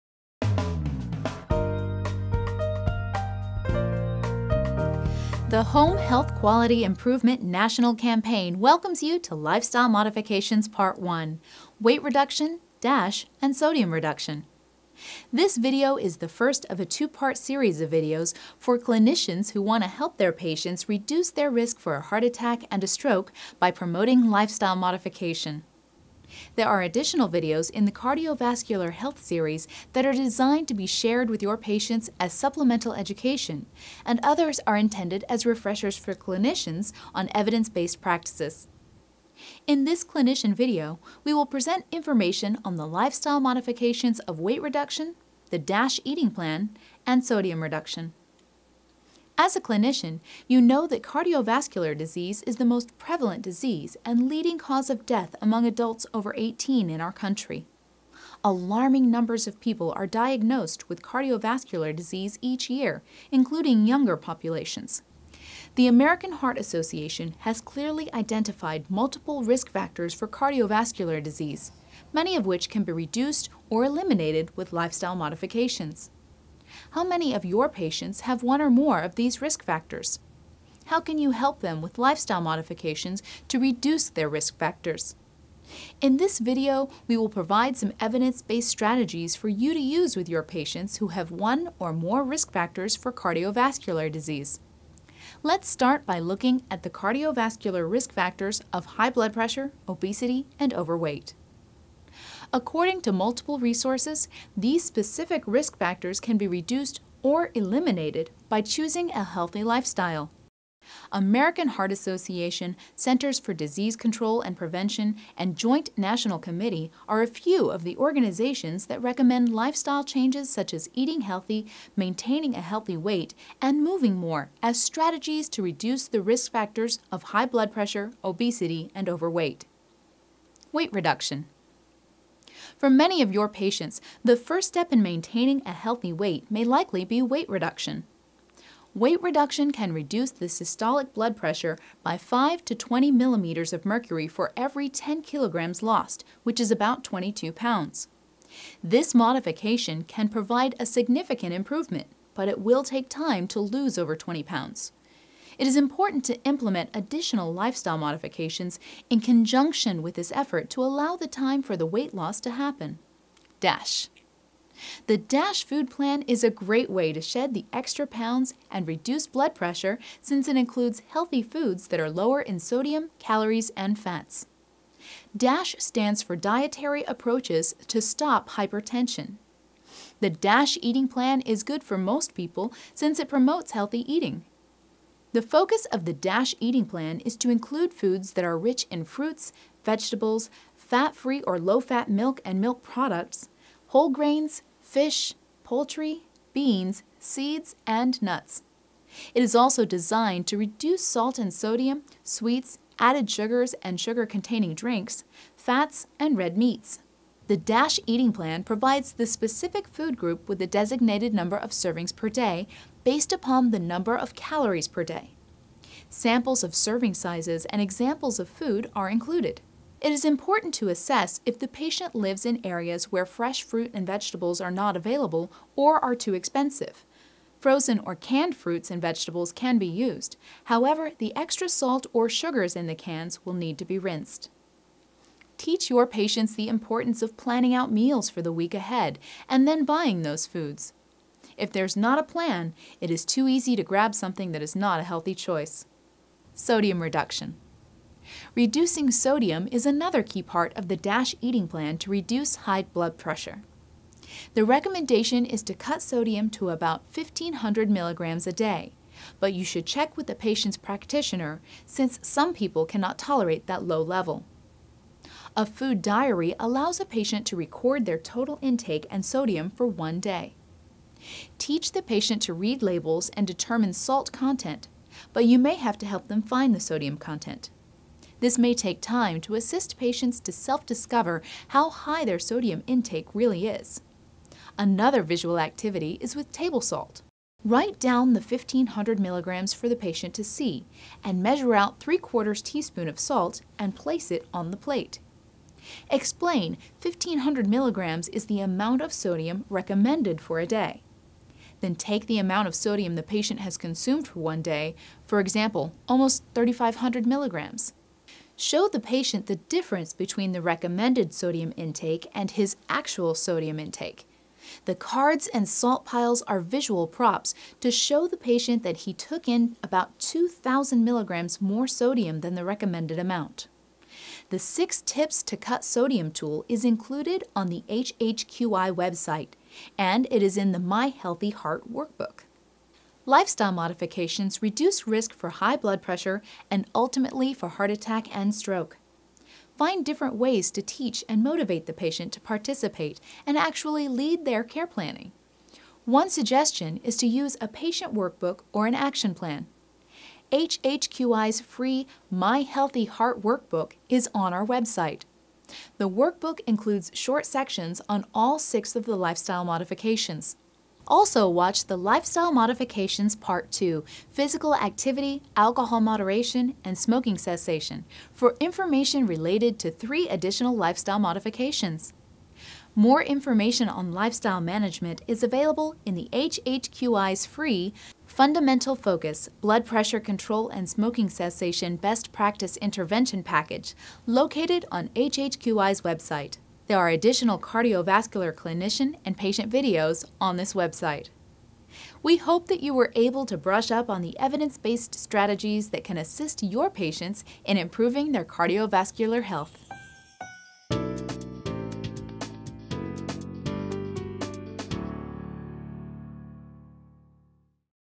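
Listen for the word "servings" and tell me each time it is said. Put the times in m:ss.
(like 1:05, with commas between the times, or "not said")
3:31, 3:36.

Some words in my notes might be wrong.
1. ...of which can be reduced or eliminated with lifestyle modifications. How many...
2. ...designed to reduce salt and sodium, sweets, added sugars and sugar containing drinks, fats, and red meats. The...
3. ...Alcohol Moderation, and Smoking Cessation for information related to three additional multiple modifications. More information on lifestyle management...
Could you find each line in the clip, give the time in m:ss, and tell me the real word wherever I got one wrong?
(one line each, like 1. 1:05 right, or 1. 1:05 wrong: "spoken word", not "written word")
1. 1:12 right
2. 3:19 right
3. 6:05 wrong: "lifestyle", not "multiple".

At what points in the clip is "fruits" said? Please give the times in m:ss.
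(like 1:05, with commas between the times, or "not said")
3:09, 3:43, 3:48.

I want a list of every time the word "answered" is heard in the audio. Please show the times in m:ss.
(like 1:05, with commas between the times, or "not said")
not said.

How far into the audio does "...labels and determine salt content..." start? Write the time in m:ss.
4:32.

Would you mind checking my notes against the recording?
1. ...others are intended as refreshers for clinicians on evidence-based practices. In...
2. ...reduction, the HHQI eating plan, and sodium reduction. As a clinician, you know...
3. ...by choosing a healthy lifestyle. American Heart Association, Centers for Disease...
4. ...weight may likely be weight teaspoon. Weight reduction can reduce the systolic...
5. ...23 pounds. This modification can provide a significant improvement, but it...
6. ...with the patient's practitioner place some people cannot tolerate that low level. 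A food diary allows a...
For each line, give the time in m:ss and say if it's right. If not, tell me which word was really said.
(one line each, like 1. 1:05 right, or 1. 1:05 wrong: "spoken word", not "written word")
1. 0:34 right
2. 0:44 wrong: "DASH", not "HHQI"
3. 1:48 right
4. 2:16 wrong: "reduction", not "teaspoon"
5. 2:27 wrong: "22", not "23"
6. 4:20 wrong: "since", not "place".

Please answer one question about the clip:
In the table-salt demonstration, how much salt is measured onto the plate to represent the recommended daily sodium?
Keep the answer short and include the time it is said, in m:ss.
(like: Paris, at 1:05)
3/4 teaspoon, at 4:52.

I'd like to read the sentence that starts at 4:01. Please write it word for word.
If there's not a plan, it is too easy to grab something that is not a healthy choice.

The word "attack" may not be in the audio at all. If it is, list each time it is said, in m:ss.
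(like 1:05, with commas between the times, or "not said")
0:22, 5:37.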